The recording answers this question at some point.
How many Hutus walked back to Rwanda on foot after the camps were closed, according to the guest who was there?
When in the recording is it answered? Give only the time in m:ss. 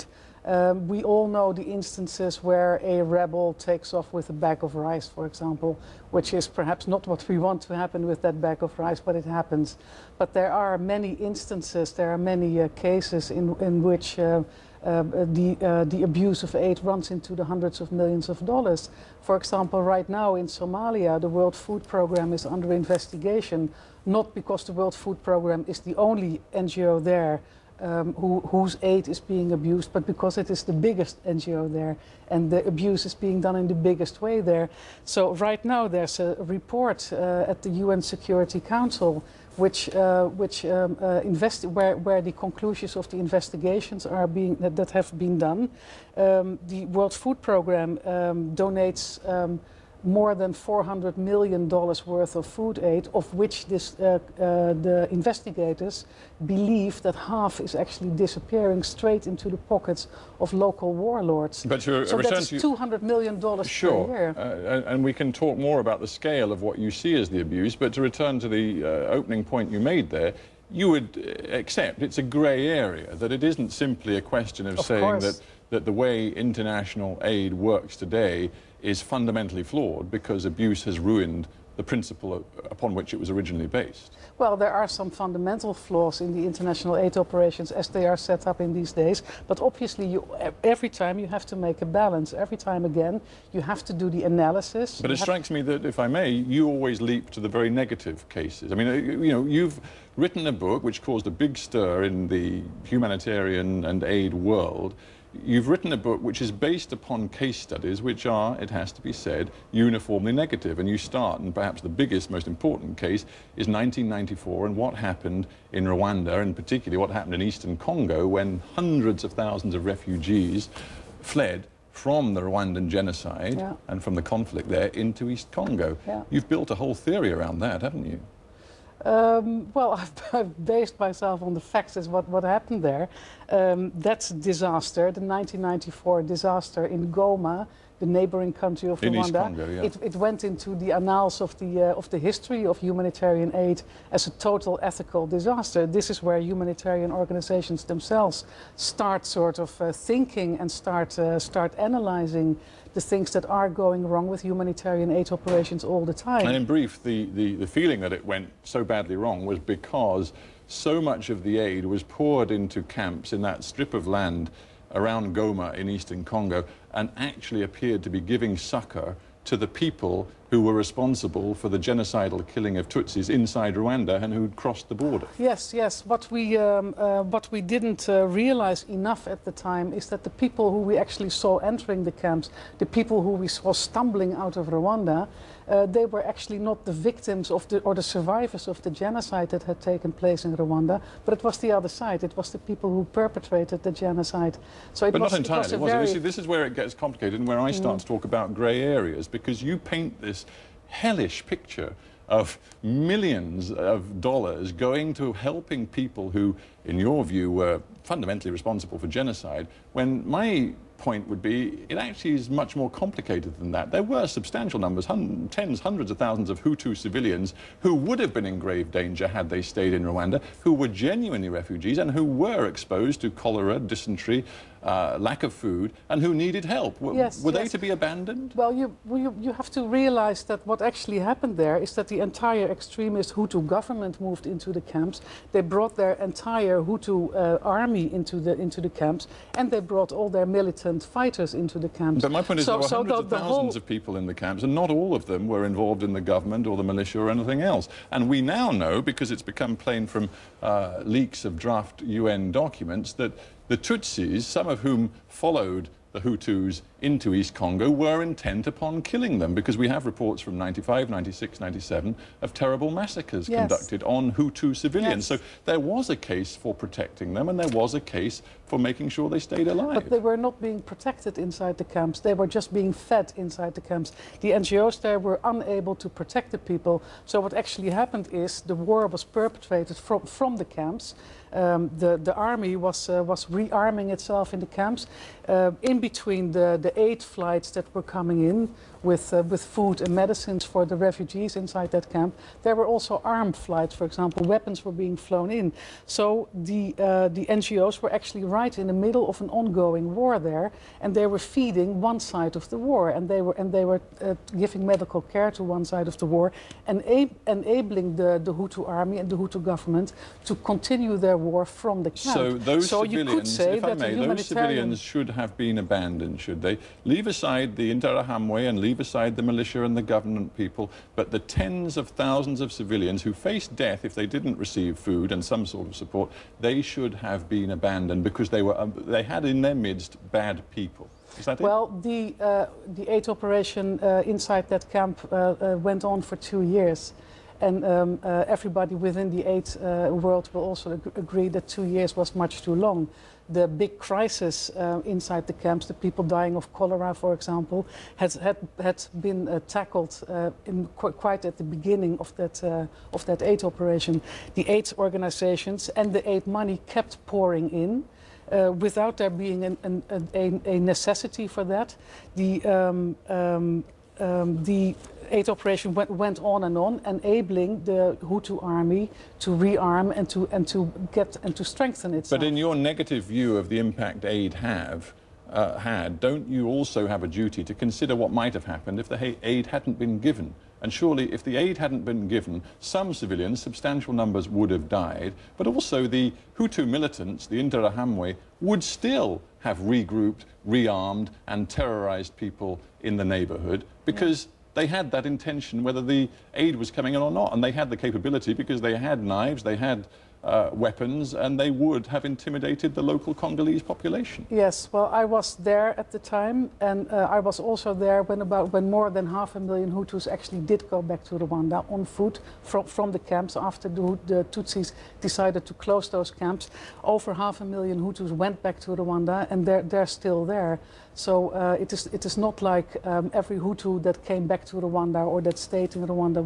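6:57.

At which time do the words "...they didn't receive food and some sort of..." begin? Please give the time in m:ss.
5:24.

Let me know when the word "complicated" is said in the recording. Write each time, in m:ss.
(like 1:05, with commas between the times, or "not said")
3:16, 3:32.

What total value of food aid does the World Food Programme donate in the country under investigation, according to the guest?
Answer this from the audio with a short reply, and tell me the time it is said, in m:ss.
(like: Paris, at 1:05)
More than $400 million, at 0:50.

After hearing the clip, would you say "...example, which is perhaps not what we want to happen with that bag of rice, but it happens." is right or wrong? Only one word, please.
right.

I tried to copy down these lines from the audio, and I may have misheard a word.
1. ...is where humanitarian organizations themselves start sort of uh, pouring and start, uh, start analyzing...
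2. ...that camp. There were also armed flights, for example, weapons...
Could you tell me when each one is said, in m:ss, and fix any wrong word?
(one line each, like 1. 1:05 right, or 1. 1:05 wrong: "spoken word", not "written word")
1. 2:26 wrong: "thinking", not "pouring"
2. 4:51 right.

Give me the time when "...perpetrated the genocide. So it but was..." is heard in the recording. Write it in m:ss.
3:13.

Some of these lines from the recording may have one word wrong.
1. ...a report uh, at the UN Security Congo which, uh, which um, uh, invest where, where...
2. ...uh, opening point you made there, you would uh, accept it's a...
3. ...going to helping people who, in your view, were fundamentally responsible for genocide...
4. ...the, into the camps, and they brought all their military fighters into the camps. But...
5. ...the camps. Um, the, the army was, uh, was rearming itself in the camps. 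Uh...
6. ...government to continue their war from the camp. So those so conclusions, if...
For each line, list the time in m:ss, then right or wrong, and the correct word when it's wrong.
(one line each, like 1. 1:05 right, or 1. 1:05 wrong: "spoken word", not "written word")
1. 0:36 wrong: "Council", not "Congo"
2. 1:08 right
3. 3:24 right
4. 3:58 right
5. 4:40 right
6. 5:09 wrong: "civilians", not "conclusions".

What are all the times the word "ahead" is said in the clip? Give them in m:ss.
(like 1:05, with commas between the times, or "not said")
not said.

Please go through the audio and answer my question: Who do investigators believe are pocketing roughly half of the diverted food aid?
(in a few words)
Local warlords.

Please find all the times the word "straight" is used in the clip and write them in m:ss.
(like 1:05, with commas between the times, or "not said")
0:58.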